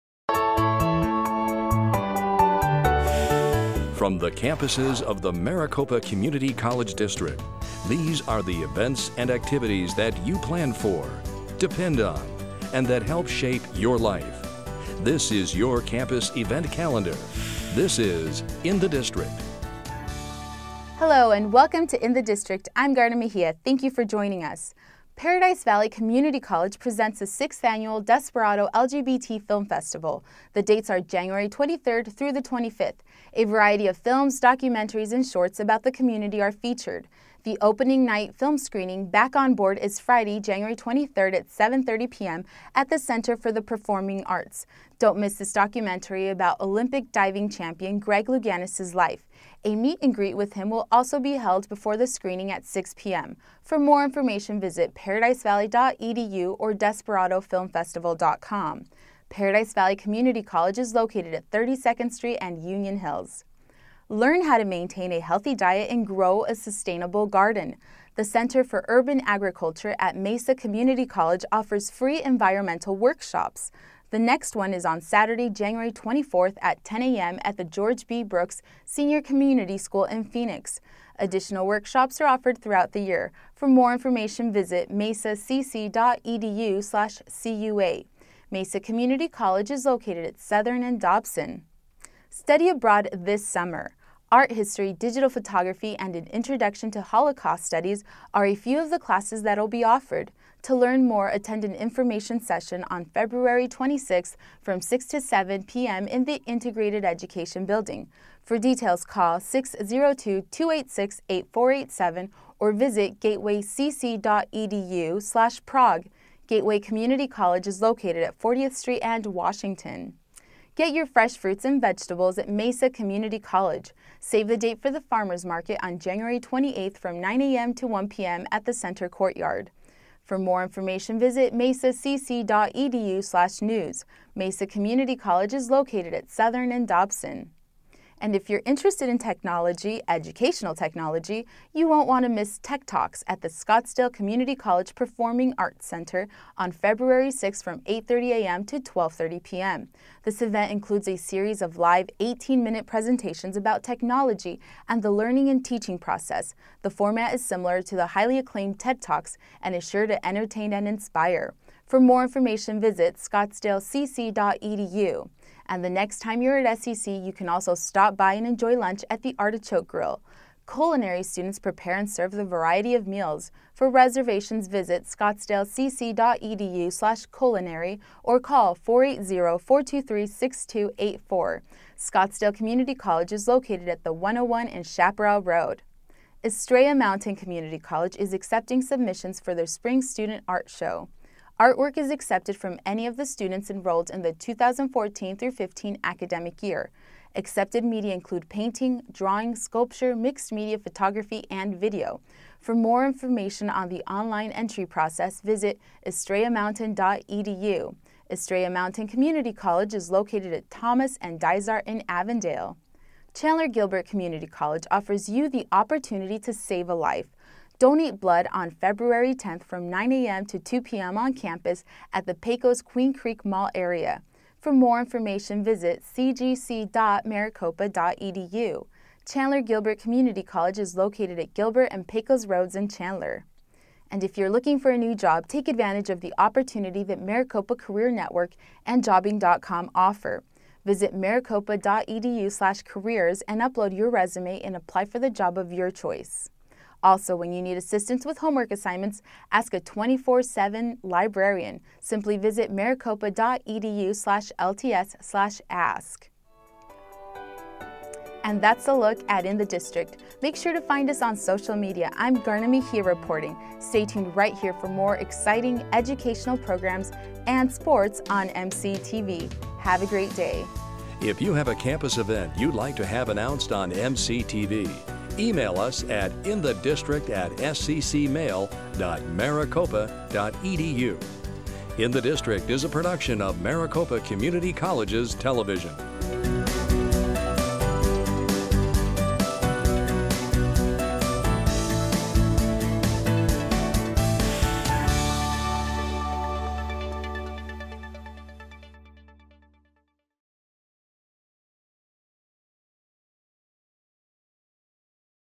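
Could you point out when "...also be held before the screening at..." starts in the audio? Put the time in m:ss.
0:50.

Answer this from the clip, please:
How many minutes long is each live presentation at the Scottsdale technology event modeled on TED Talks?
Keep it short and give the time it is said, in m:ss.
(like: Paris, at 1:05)
18, at 2:32.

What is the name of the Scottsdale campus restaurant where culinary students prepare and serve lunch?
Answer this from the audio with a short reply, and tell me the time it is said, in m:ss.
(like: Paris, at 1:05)
Artichoke Grill, at 2:49.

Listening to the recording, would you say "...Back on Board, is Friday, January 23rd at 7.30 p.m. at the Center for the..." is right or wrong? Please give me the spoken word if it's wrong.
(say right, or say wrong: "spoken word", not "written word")
right.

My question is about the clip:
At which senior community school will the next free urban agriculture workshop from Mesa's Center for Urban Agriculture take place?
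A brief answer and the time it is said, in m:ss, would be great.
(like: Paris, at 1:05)
George B. Brooks Senior Community School, at 1:17.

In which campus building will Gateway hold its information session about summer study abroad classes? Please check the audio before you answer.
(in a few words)
Integrated Education Building.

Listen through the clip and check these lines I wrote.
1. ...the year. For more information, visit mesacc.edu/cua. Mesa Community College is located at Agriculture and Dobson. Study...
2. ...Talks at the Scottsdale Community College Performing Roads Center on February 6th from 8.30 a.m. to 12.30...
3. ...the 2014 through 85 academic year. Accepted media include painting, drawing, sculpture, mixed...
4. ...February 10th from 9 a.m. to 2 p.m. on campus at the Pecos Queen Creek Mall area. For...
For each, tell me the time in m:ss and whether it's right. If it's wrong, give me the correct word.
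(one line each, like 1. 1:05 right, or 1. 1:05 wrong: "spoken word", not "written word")
1. 1:22 wrong: "Southern", not "Agriculture"
2. 2:22 wrong: "Arts", not "Roads"
3. 3:14 wrong: "15", not "85"
4. 3:38 right.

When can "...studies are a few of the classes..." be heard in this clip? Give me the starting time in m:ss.
1:37.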